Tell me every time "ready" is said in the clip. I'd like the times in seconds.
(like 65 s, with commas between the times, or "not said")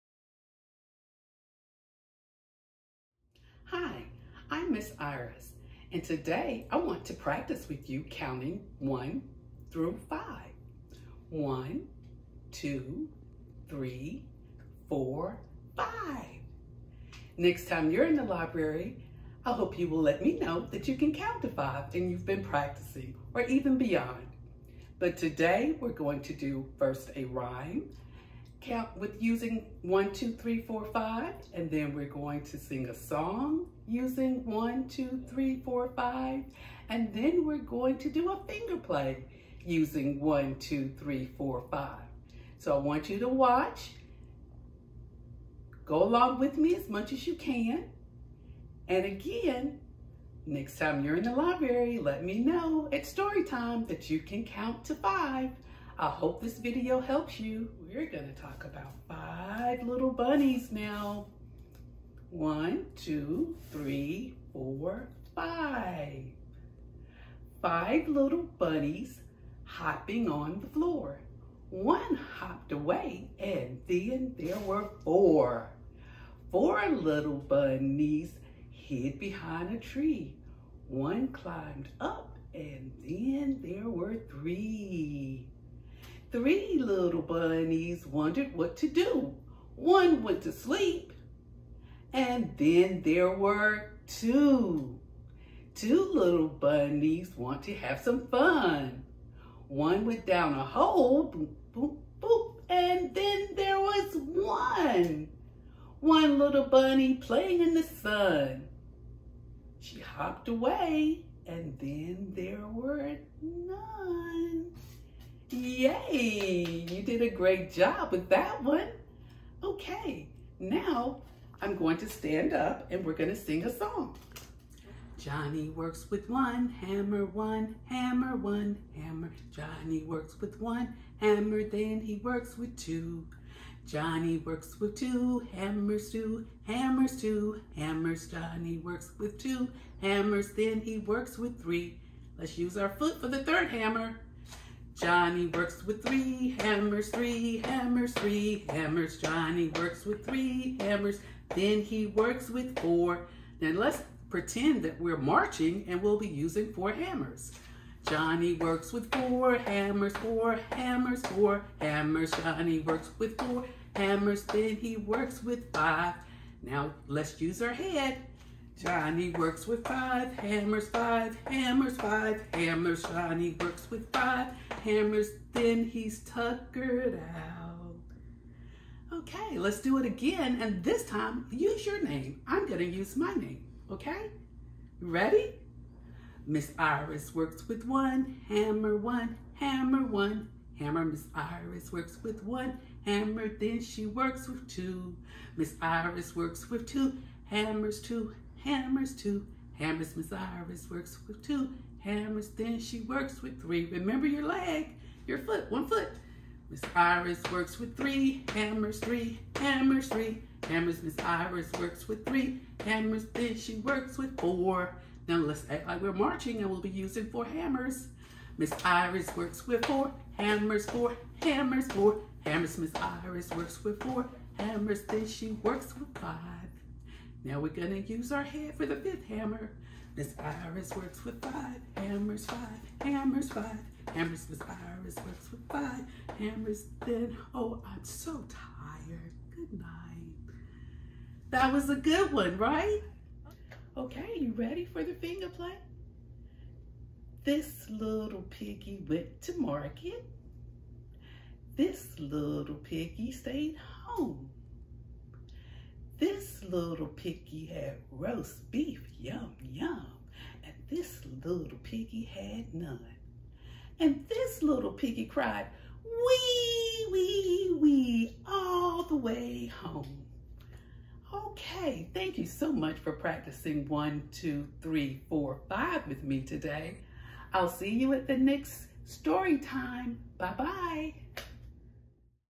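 184 s, 244 s.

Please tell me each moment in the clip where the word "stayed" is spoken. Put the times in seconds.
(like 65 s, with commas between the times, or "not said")
253 s.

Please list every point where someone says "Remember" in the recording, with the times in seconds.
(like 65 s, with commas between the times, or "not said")
203 s.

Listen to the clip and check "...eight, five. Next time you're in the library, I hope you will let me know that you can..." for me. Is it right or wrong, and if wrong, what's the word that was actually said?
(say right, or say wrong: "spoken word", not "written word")
wrong: "four", not "eight".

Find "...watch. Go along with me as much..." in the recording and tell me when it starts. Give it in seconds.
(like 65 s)
43 s.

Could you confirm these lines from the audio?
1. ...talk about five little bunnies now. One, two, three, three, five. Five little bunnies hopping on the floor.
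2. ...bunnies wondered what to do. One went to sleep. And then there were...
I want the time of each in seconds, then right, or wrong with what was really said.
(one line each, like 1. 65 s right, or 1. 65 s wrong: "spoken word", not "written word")
1. 58 s wrong: "four", not "three"
2. 87 s right.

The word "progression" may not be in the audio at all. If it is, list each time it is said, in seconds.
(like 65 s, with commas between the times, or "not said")
not said.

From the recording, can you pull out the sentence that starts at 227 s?
Now we're gonna use our head for the fifth hammer.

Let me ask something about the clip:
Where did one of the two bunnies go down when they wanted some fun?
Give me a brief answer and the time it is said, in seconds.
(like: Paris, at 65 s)
A hole, at 100 s.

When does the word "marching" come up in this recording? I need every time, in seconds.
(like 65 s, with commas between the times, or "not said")
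155 s, 216 s.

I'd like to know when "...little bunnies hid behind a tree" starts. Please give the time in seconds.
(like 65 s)
76 s.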